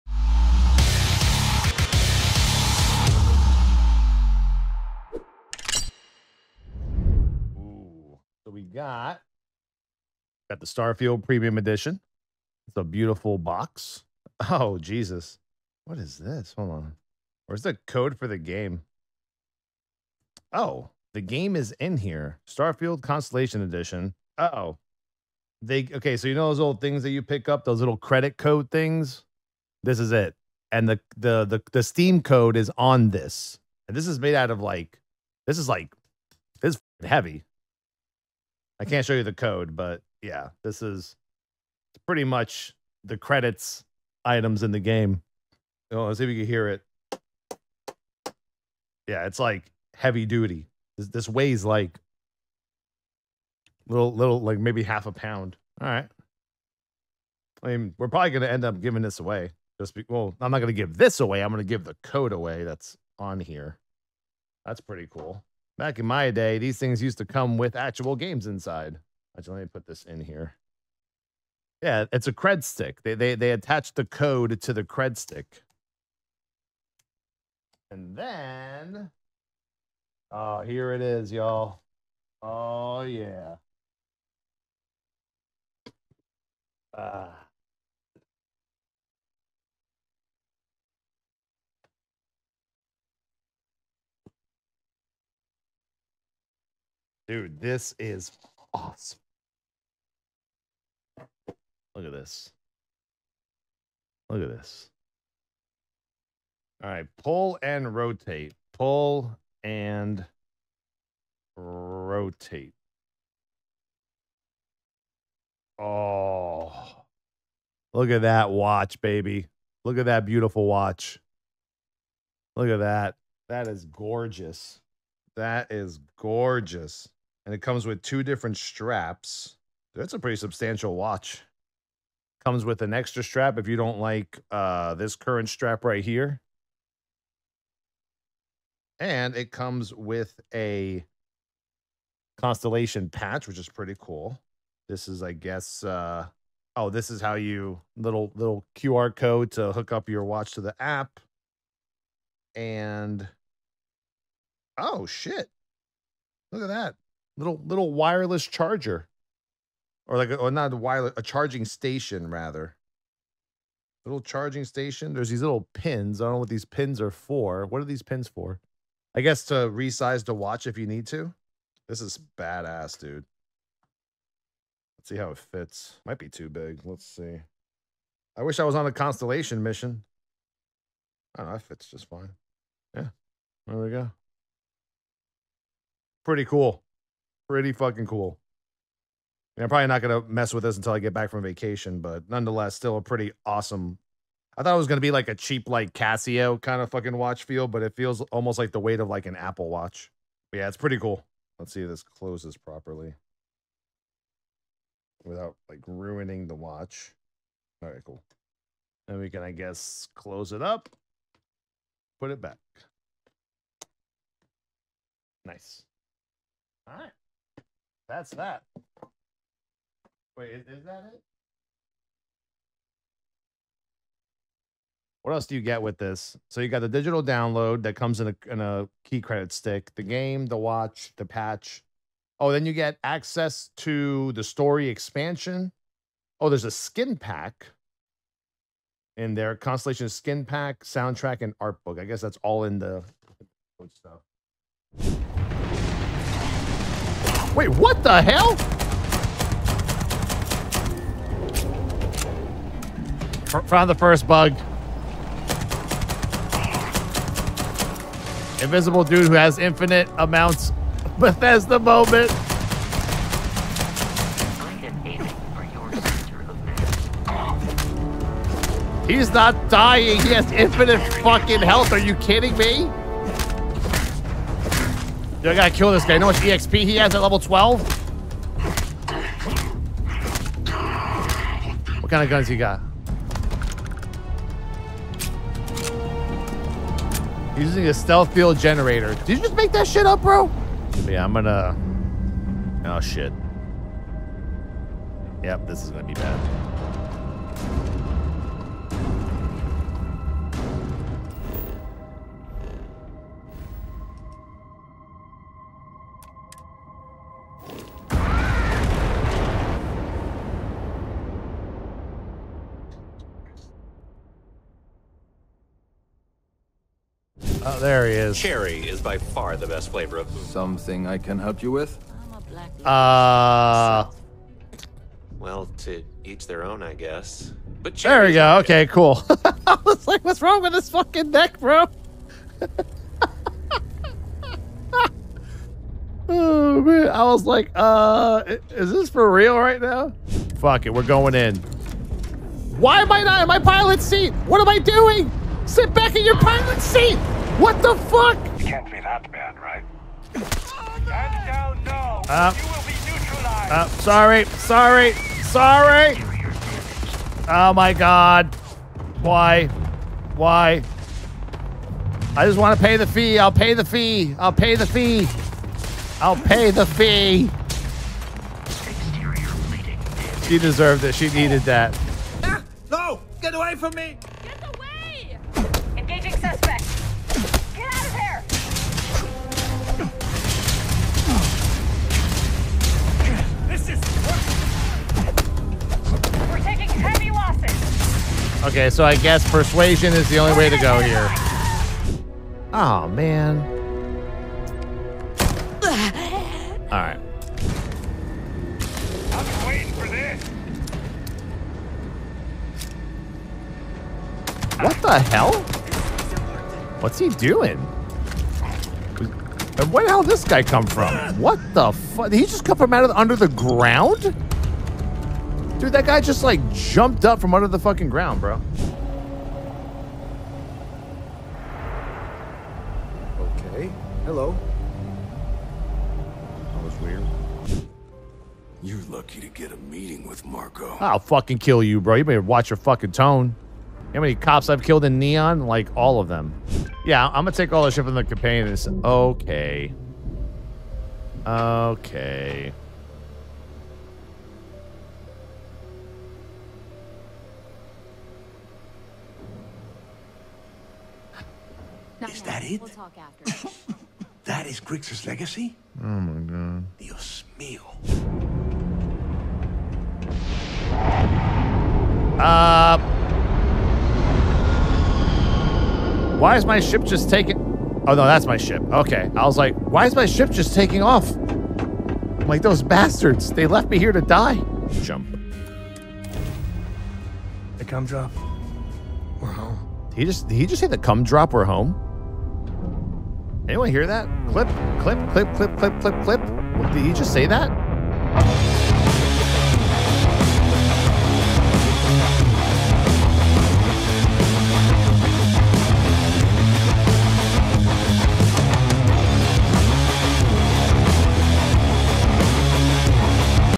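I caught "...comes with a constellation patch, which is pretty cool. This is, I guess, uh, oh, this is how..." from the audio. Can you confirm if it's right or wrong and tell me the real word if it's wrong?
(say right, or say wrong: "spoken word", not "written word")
right.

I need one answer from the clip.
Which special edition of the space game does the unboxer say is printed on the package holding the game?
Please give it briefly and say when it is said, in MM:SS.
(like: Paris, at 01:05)
Constellation Edition, at 00:22.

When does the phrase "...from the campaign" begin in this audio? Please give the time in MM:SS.
07:18.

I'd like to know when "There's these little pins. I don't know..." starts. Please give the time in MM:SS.
02:45.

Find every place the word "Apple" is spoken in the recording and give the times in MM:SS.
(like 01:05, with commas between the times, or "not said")
03:19.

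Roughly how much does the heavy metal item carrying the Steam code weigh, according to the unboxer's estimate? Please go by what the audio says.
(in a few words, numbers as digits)
half a pound.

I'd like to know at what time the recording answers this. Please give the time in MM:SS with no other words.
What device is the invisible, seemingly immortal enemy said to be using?
04:47.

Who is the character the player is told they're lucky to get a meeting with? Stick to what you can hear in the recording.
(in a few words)
Marco.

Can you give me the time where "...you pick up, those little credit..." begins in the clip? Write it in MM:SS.
00:27.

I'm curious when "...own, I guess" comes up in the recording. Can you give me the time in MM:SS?
05:26.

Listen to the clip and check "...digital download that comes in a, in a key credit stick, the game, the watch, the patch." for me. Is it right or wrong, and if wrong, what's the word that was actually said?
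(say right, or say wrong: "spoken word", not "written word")
right.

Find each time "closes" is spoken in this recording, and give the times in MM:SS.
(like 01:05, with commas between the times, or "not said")
03:22, 03:30.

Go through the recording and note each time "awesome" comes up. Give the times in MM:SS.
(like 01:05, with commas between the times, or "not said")
01:38, 03:13.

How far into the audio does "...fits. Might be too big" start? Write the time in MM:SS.
02:55.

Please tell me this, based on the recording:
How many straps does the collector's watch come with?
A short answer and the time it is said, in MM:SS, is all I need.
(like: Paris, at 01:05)
2, at 02:08.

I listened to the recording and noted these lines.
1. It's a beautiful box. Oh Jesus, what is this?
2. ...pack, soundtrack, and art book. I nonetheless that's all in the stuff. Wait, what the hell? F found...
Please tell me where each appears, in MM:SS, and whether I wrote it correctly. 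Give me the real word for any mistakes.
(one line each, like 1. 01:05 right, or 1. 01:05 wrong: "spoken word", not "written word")
1. 00:12 right
2. 04:00 wrong: "guess", not "nonetheless".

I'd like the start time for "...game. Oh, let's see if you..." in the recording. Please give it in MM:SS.
00:44.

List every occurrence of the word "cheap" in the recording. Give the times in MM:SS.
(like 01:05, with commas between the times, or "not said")
03:15.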